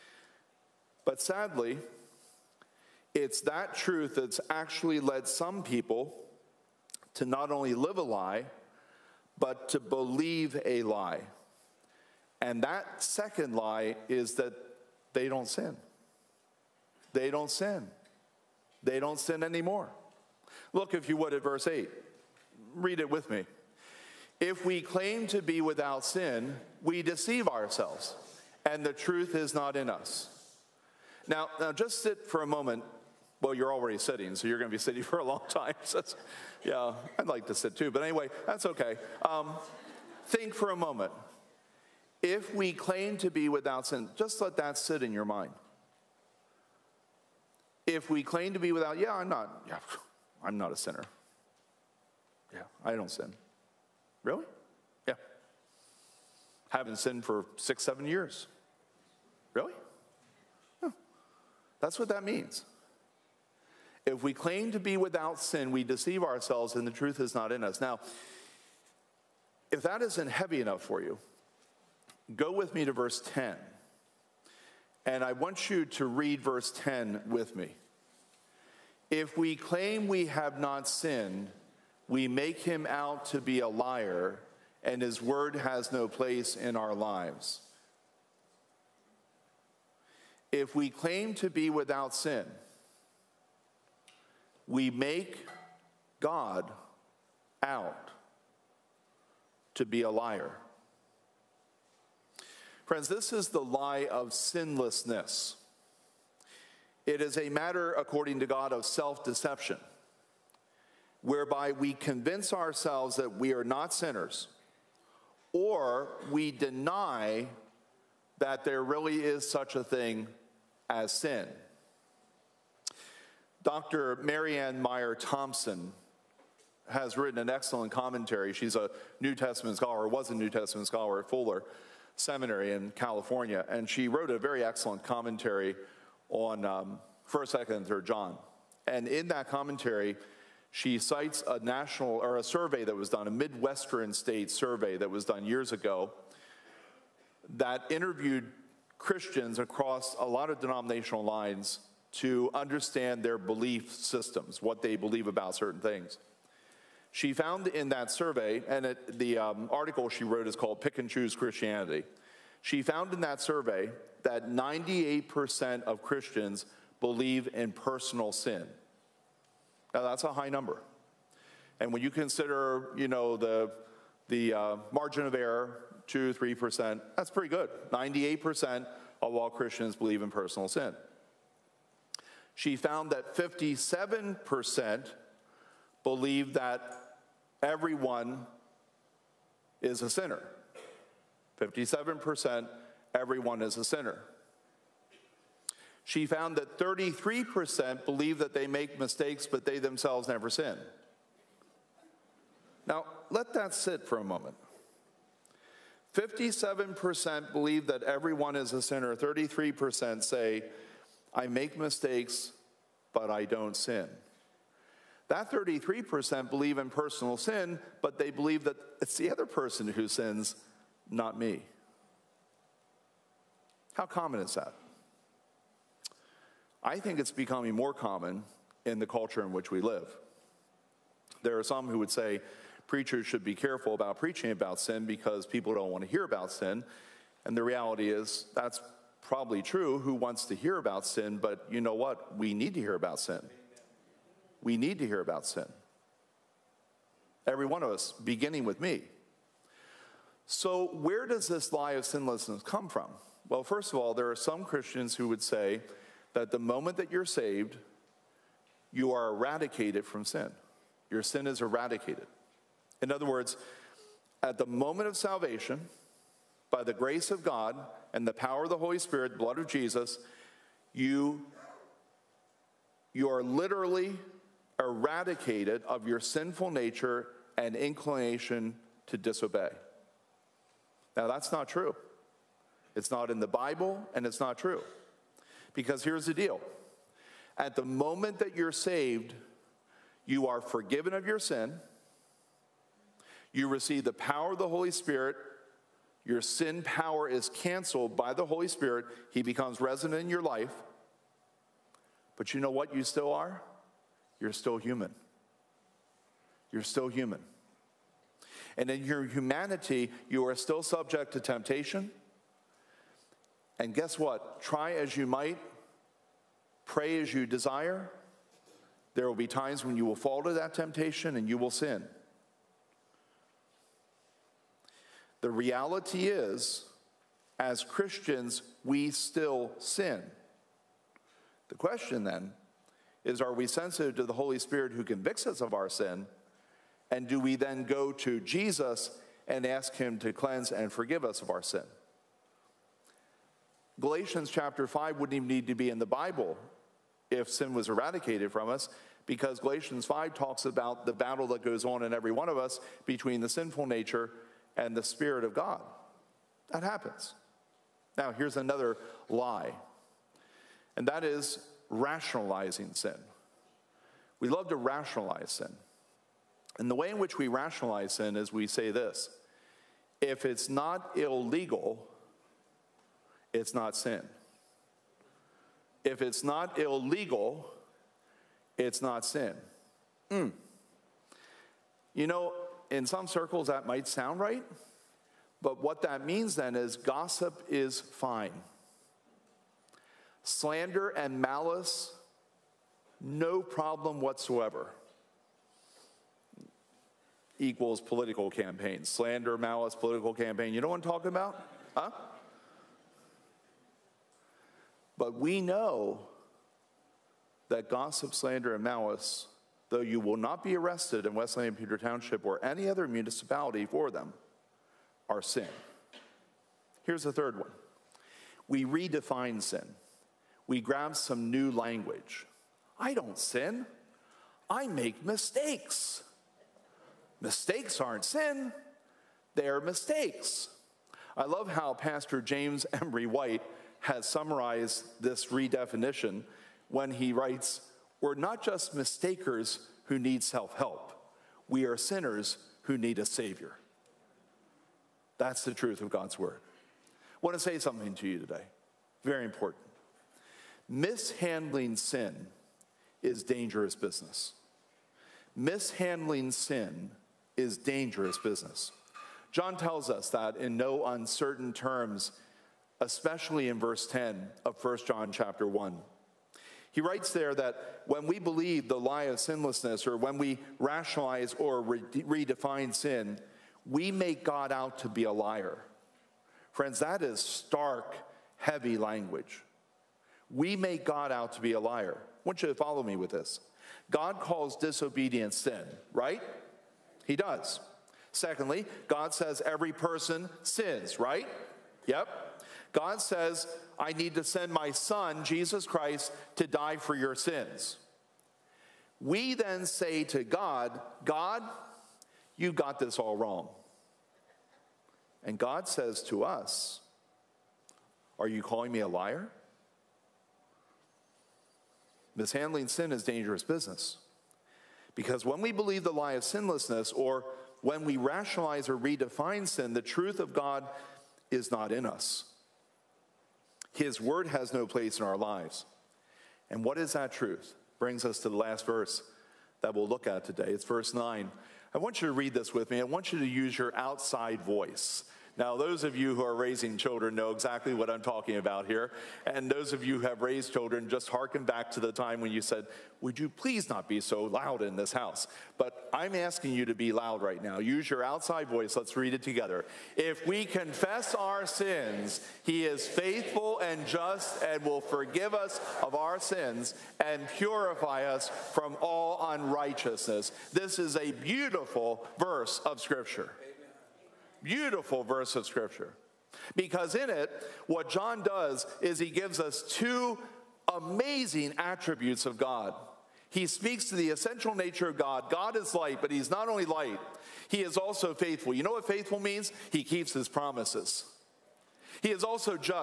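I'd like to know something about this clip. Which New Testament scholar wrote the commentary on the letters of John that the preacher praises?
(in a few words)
Marianne Meye Thompson.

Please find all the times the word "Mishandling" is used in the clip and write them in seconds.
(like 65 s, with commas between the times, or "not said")
450 s, 455 s, 512 s.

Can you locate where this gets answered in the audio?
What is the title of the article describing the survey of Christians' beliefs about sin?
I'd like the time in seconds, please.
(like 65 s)
160 s.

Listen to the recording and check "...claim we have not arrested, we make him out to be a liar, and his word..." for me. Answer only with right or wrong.
wrong.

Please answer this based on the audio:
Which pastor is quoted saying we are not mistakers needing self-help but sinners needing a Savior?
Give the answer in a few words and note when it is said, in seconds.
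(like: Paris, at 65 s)
James Emery White, at 432 s.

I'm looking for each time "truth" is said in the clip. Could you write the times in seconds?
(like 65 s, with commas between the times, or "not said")
3 s, 28 s, 66 s, 445 s, 520 s, 527 s.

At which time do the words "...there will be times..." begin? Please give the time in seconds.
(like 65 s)
319 s.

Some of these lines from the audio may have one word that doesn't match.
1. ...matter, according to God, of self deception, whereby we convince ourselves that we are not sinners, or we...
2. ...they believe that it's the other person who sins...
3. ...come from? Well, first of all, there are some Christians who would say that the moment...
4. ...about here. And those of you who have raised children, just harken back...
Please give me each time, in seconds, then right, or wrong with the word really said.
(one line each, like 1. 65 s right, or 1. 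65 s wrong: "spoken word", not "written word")
1. 107 s right
2. 218 s right
3. 252 s right
4. 538 s right.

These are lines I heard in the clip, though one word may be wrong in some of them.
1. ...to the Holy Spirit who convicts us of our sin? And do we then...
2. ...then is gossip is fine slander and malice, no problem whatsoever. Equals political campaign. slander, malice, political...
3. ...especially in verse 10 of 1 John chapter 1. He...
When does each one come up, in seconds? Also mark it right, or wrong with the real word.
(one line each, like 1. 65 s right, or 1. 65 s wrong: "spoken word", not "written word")
1. 334 s right
2. 386 s right
3. 463 s right.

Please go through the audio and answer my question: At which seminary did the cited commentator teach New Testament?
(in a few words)
Fuller.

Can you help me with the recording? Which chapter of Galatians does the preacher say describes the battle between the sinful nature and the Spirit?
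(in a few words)
Chapter 5.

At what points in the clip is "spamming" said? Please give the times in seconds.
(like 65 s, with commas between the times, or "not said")
not said.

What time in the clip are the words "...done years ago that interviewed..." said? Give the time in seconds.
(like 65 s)
145 s.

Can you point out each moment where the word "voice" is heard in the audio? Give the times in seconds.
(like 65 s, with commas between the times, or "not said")
534 s, 548 s.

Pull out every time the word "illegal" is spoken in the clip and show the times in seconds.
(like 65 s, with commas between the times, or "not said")
371 s, 376 s.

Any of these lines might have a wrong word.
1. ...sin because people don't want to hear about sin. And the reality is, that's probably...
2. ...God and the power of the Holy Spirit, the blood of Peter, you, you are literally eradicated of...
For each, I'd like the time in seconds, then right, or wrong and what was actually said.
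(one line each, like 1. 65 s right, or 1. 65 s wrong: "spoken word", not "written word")
1. 234 s right
2. 267 s wrong: "Jesus", not "Peter".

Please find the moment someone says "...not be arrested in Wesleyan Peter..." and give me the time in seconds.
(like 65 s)
410 s.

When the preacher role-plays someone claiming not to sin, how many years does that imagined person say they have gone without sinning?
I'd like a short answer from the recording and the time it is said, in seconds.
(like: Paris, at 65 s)
6, 7 years, at 57 s.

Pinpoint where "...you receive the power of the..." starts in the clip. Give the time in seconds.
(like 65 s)
293 s.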